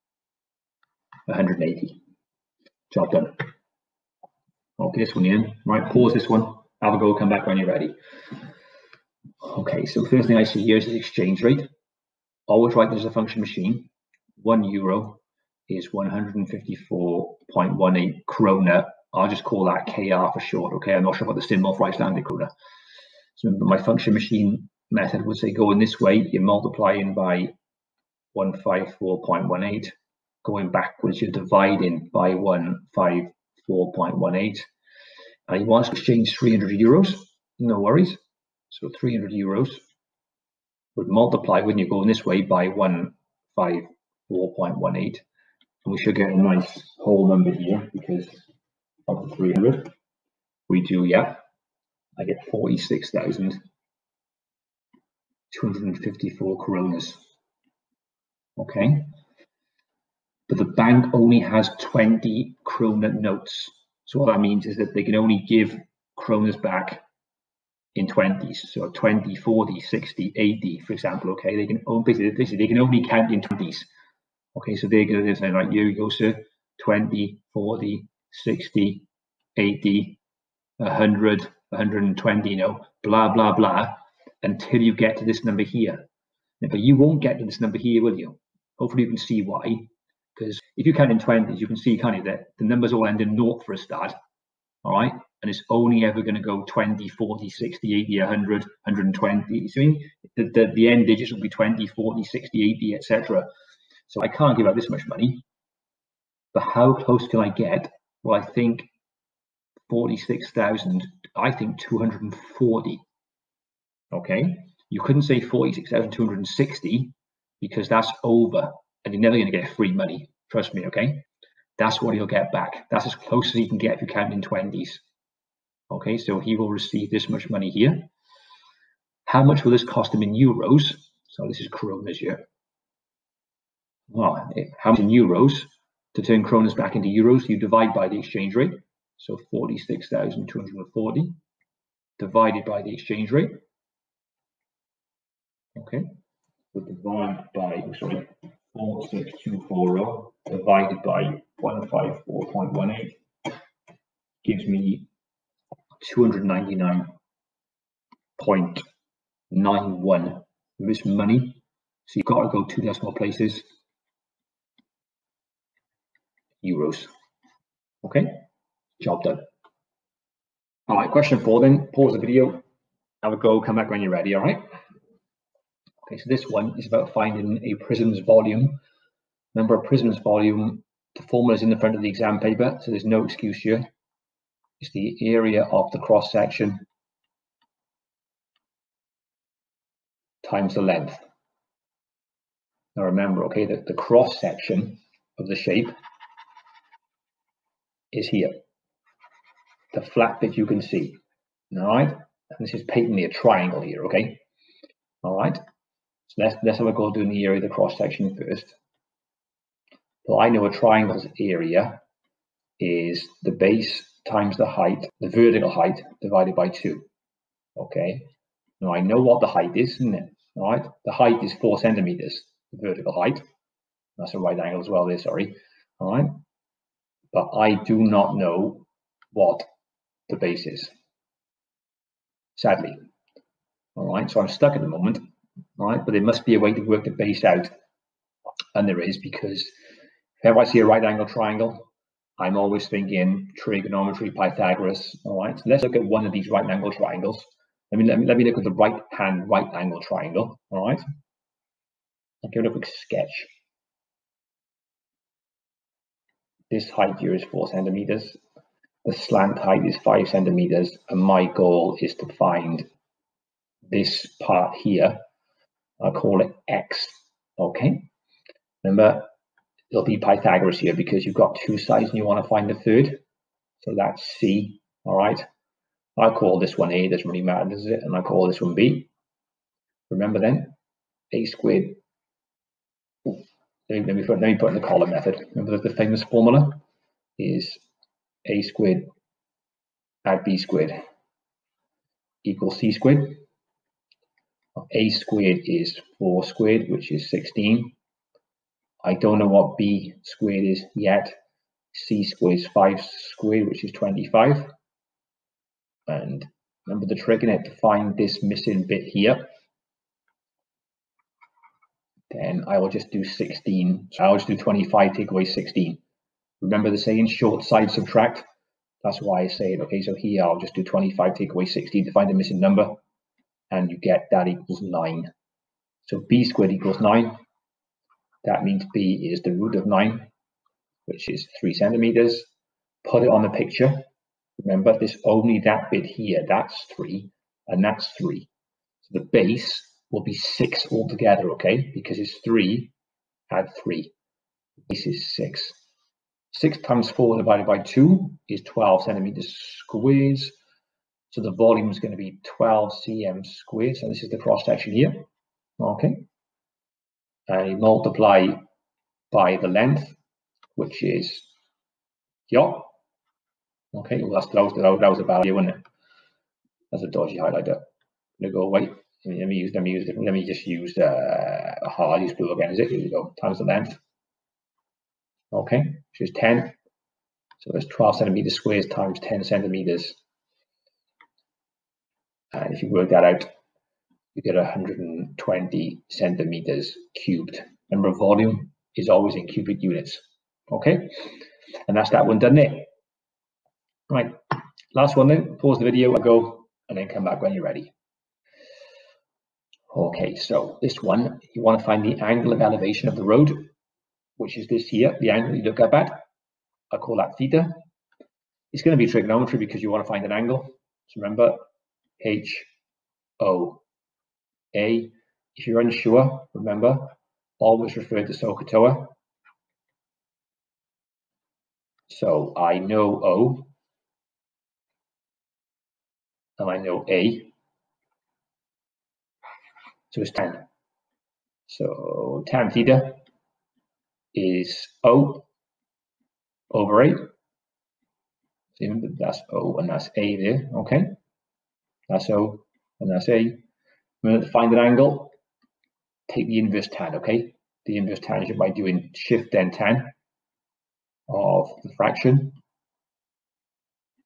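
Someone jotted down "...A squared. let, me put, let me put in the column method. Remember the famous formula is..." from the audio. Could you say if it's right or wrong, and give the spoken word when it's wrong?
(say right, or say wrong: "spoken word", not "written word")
right.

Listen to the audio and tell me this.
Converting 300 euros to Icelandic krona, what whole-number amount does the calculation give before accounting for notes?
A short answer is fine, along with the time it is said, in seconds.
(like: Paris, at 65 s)
46,254, at 52 s.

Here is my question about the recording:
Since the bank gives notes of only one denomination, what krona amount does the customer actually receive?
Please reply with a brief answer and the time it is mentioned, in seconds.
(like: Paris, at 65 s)
46,240, at 109 s.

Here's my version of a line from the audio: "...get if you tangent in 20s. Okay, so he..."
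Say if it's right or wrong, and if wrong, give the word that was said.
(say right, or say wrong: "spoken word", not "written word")
wrong: "count", not "tangent".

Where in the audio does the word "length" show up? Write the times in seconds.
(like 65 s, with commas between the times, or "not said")
190 s, 359 s, 373 s.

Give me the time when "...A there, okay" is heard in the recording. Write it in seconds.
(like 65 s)
440 s.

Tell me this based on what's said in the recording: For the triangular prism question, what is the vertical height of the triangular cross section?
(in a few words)
4 centimeters.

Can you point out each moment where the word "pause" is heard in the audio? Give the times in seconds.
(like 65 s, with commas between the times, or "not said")
5 s, 171 s, 395 s.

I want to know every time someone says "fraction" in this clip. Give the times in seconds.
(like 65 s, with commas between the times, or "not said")
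451 s.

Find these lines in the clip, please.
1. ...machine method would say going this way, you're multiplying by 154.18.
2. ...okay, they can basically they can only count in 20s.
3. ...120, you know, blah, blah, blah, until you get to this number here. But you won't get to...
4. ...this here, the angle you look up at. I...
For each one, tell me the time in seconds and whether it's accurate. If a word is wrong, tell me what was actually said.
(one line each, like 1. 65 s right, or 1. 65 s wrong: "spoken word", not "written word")
1. 24 s right
2. 71 s right
3. 81 s right
4. 404 s right.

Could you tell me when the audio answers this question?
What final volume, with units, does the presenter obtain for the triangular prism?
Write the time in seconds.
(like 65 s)
384 s.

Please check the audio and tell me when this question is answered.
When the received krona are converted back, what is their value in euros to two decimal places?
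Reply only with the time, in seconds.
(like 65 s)
156 s.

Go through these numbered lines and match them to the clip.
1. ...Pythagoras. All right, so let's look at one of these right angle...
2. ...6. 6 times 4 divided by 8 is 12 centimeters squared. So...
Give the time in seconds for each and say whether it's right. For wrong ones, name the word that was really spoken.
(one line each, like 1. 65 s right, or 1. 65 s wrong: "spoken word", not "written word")
1. 244 s right
2. 345 s wrong: "2", not "8".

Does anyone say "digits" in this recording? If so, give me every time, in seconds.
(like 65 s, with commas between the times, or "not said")
101 s.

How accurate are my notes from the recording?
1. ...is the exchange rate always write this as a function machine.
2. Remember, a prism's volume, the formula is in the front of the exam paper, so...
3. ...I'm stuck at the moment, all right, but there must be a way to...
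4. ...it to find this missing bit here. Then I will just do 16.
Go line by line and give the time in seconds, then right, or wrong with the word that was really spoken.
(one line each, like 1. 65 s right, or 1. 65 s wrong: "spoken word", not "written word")
1. 10 s right
2. 179 s right
3. 234 s right
4. 307 s right.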